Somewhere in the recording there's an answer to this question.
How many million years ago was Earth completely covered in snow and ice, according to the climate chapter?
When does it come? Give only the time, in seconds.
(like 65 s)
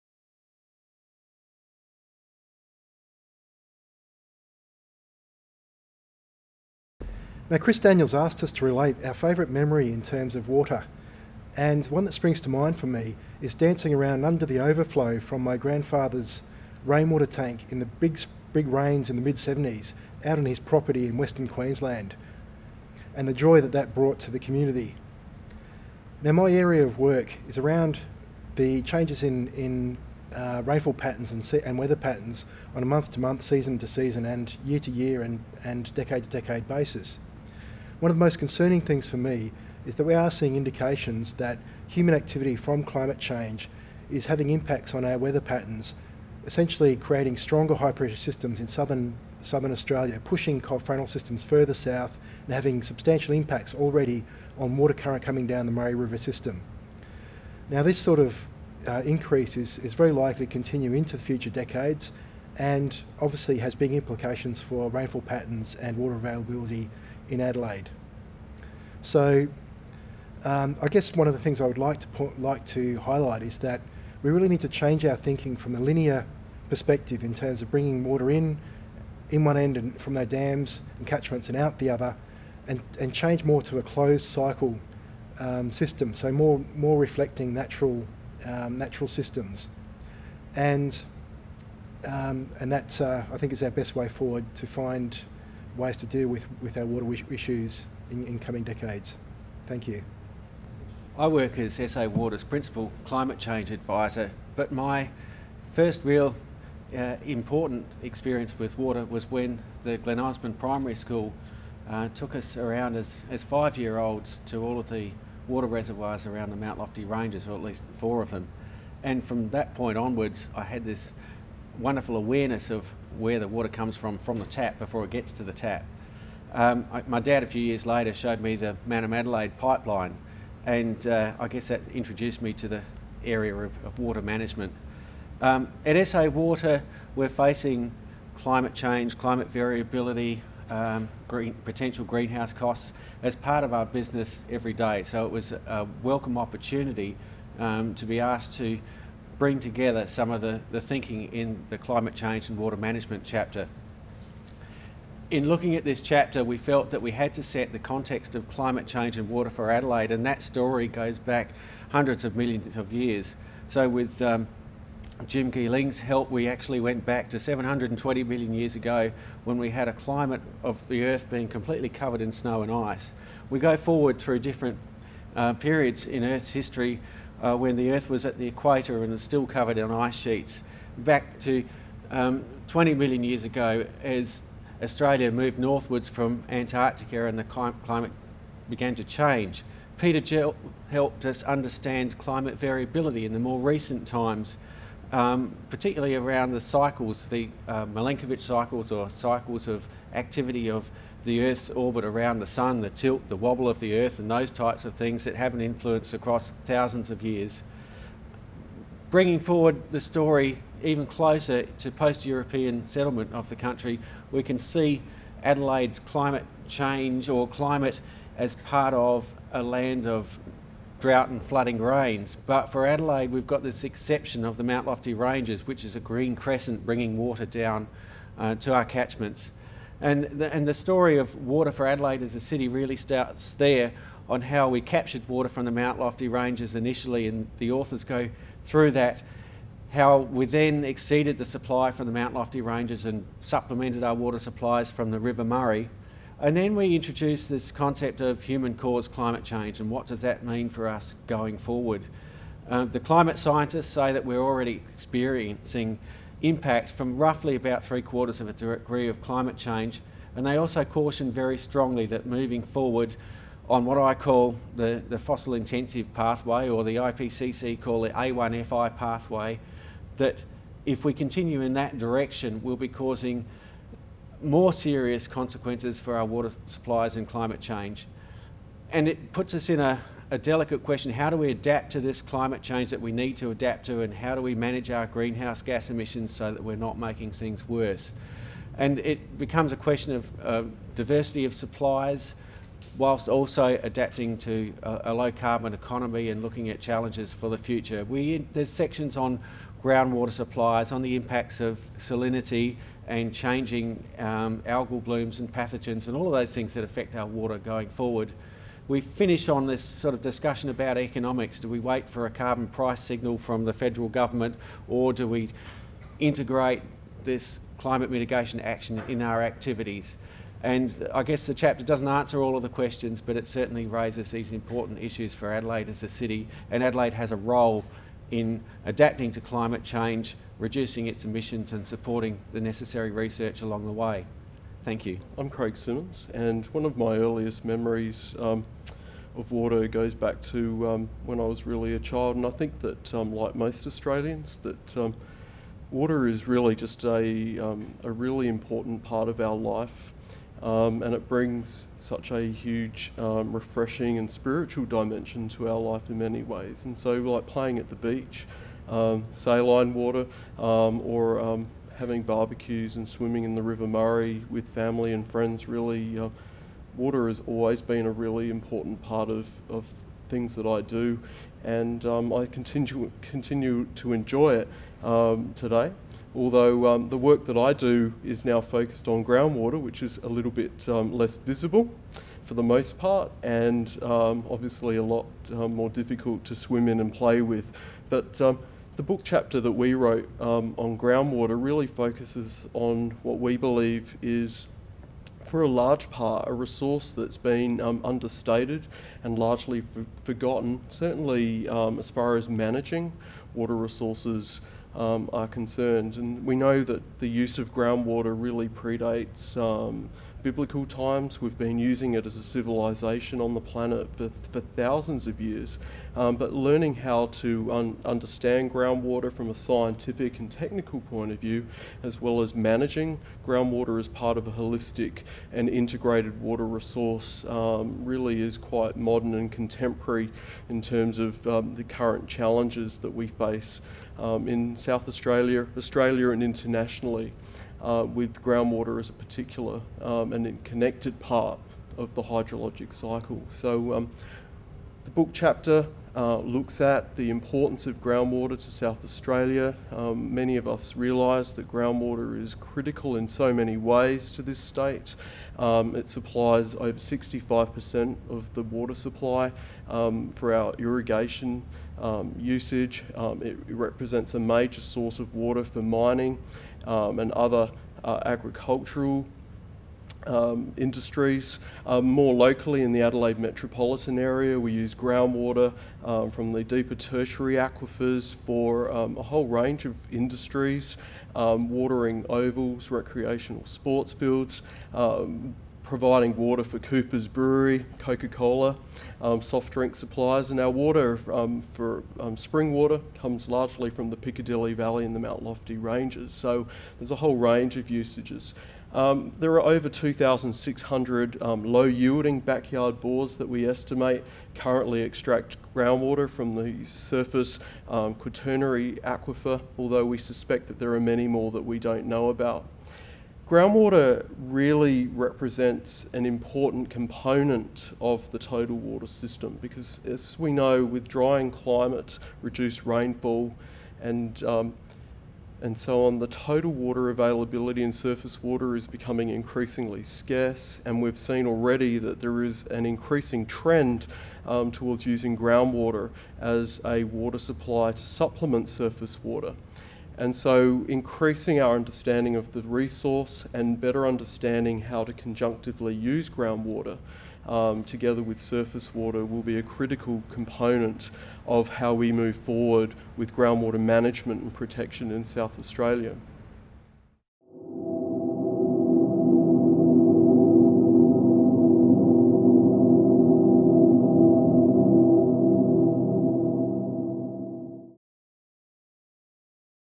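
167 s.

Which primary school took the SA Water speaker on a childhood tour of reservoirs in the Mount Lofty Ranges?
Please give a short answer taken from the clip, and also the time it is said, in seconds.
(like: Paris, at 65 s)
Glen Osmond Primary School, at 109 s.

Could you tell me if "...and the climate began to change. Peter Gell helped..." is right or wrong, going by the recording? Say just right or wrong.
right.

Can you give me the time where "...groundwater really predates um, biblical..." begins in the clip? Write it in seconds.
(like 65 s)
407 s.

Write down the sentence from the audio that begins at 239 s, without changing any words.
How we then exceeded the supply from the Mount Lofty Ranges and supplemented our water supplies from the River Murray.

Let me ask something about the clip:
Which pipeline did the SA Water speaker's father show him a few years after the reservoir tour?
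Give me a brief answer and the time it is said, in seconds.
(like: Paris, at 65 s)
Mannum to Adelaide pipeline, at 128 s.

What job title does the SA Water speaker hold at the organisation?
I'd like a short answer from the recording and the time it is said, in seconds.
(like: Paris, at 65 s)
Principal Climate Change Advisor, at 102 s.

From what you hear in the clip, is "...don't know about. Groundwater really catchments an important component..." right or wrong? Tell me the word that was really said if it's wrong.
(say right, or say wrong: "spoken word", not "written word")
wrong: "represents", not "catchments".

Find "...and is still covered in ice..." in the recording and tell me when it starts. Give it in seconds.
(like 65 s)
179 s.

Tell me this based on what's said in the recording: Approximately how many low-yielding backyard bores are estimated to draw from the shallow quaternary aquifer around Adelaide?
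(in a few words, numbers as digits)
over 2,600.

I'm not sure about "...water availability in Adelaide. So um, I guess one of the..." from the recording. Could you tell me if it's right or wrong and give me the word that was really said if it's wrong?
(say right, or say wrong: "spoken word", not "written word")
right.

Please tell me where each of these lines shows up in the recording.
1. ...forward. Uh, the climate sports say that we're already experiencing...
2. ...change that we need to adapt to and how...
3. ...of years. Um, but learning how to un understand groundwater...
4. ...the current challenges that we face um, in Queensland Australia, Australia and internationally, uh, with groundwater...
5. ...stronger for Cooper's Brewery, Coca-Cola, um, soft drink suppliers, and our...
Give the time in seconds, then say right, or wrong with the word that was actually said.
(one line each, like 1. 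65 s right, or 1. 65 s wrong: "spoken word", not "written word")
1. 251 s wrong: "scientists", not "sports"
2. 282 s right
3. 415 s right
4. 431 s wrong: "South", not "Queensland"
5. 486 s wrong: "water", not "stronger".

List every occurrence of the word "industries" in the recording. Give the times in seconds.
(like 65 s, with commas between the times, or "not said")
470 s, 480 s.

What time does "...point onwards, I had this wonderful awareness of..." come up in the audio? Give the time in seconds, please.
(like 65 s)
119 s.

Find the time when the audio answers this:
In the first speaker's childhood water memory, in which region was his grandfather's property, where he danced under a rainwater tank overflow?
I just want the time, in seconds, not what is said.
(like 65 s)
21 s.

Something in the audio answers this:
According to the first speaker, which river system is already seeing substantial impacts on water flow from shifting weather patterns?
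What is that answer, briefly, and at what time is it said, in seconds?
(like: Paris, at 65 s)
Murray River, at 55 s.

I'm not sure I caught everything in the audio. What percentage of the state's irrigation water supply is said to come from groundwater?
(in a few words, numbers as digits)
over 65%.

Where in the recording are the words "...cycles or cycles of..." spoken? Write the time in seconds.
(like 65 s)
198 s.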